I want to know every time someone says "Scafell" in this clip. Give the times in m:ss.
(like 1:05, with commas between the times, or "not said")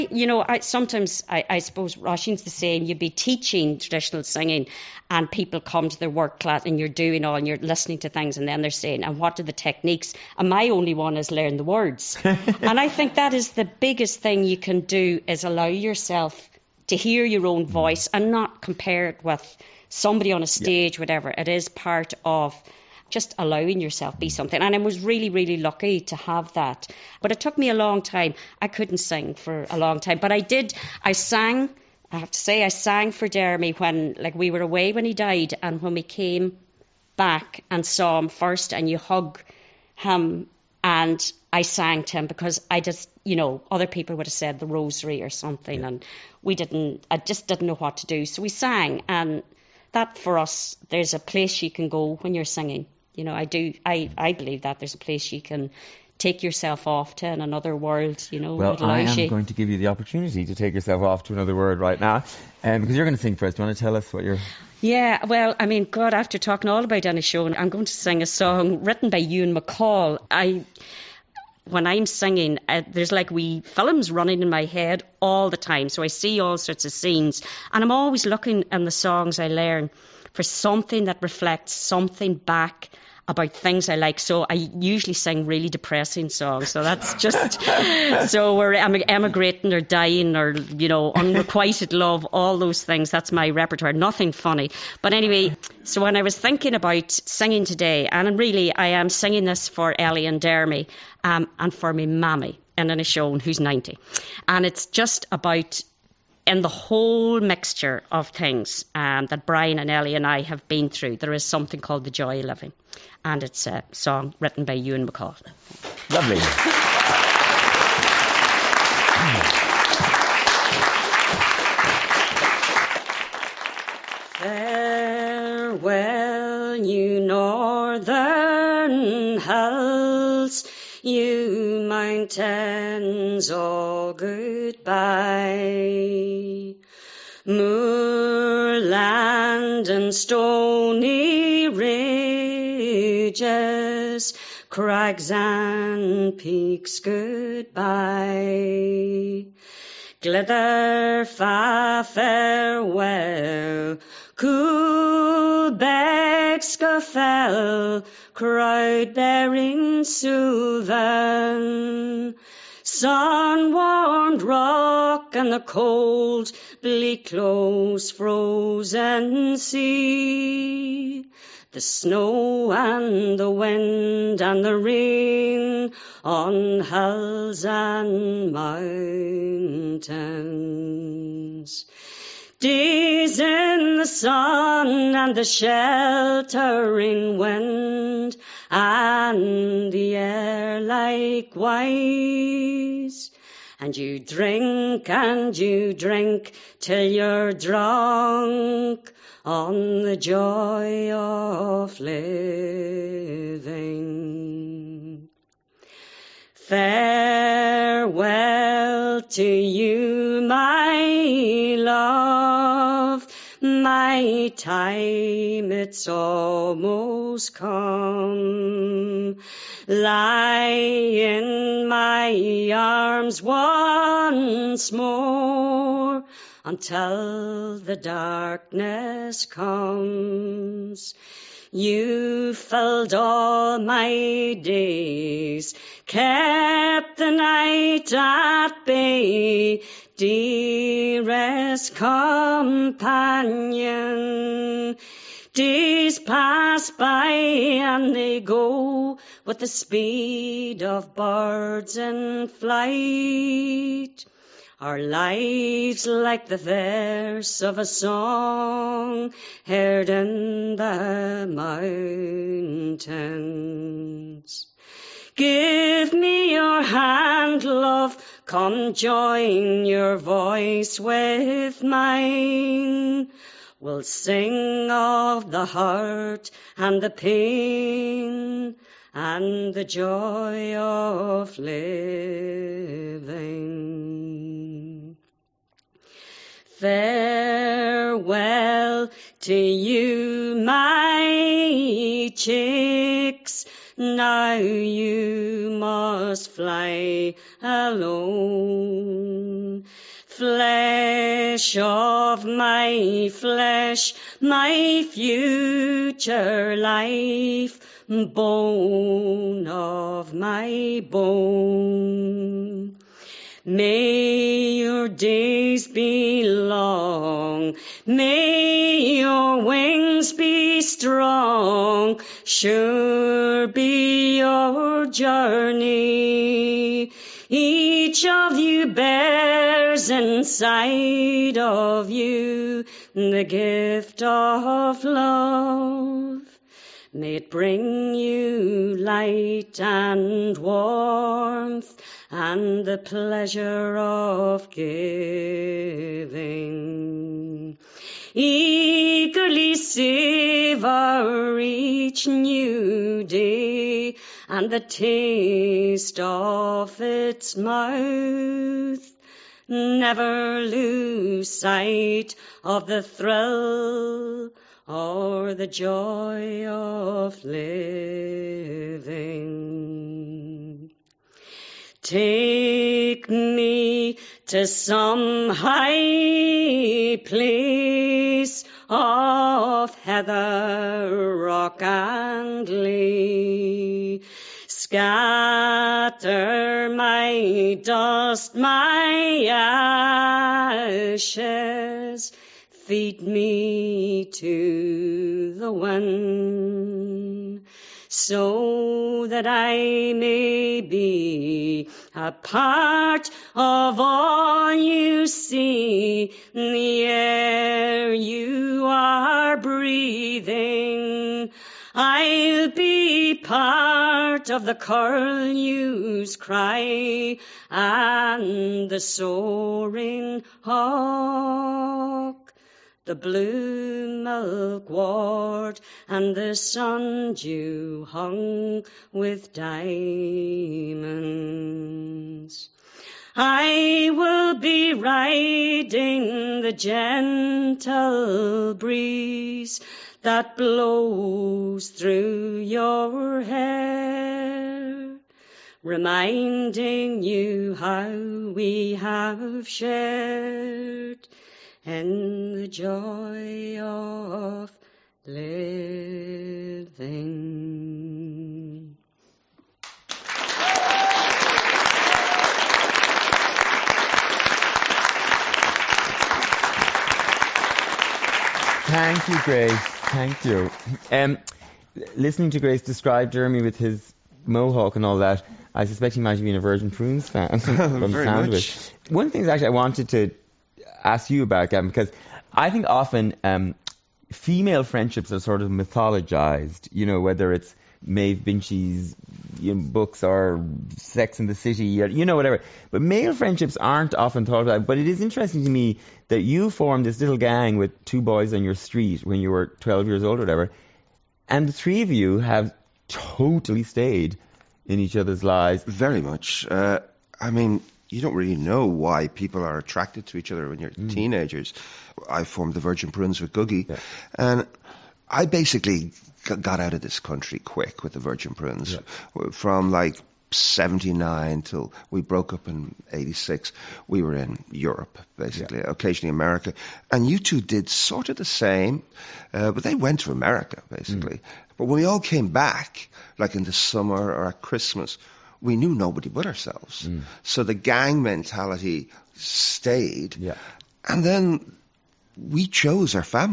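2:36.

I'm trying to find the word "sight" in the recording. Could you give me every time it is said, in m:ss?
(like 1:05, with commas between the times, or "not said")
6:01.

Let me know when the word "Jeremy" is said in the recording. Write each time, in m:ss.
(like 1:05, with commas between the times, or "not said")
0:33, 7:53.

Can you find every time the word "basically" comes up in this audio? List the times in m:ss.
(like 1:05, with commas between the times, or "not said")
8:35, 8:45, 8:50.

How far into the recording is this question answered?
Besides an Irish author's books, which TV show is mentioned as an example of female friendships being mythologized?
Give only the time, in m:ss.
8:10.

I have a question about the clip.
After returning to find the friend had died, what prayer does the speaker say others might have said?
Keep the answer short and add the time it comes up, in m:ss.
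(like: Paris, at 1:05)
the rosary, at 0:44.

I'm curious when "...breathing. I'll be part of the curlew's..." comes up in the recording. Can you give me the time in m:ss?
6:49.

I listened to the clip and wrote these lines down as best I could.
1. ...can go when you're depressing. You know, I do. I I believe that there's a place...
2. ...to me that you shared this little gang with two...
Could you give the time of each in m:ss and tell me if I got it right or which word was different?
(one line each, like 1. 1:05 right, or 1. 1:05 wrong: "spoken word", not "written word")
1. 0:51 wrong: "singing", not "depressing"
2. 8:15 wrong: "formed", not "shared".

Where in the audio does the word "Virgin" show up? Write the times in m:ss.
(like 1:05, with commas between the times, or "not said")
7:56, 8:32, 8:38.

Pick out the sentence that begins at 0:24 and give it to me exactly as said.
And I was really, really lucky to have that.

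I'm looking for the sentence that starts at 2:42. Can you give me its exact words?
Sun-warmed rock and the cold, bleak, close, frozen sea.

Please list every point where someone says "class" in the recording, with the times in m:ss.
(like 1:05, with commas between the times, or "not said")
0:06.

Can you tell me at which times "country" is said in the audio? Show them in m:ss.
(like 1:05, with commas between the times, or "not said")
8:37.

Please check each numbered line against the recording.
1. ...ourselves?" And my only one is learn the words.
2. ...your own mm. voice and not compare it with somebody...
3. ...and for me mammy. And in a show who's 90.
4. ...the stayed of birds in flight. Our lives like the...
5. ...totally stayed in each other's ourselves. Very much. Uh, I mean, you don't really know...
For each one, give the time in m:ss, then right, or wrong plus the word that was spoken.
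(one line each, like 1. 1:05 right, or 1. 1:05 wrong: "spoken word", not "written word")
1. 0:09 wrong: "techniques", not "ourselves"
2. 0:17 right
3. 1:41 right
4. 4:09 wrong: "speed", not "stayed"
5. 8:23 wrong: "lives", not "ourselves".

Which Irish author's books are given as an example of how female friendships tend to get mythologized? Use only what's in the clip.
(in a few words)
Maeve Binchy.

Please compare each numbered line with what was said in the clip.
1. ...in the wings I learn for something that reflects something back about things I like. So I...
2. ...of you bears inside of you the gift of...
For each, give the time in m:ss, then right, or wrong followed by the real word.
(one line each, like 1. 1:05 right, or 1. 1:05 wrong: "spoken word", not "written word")
1. 1:18 wrong: "songs", not "wings"
2. 5:28 right.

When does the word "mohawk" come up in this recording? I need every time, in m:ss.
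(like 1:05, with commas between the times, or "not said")
7:54.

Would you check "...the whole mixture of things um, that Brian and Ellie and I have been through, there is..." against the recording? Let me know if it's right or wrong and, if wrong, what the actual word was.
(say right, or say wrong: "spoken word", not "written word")
right.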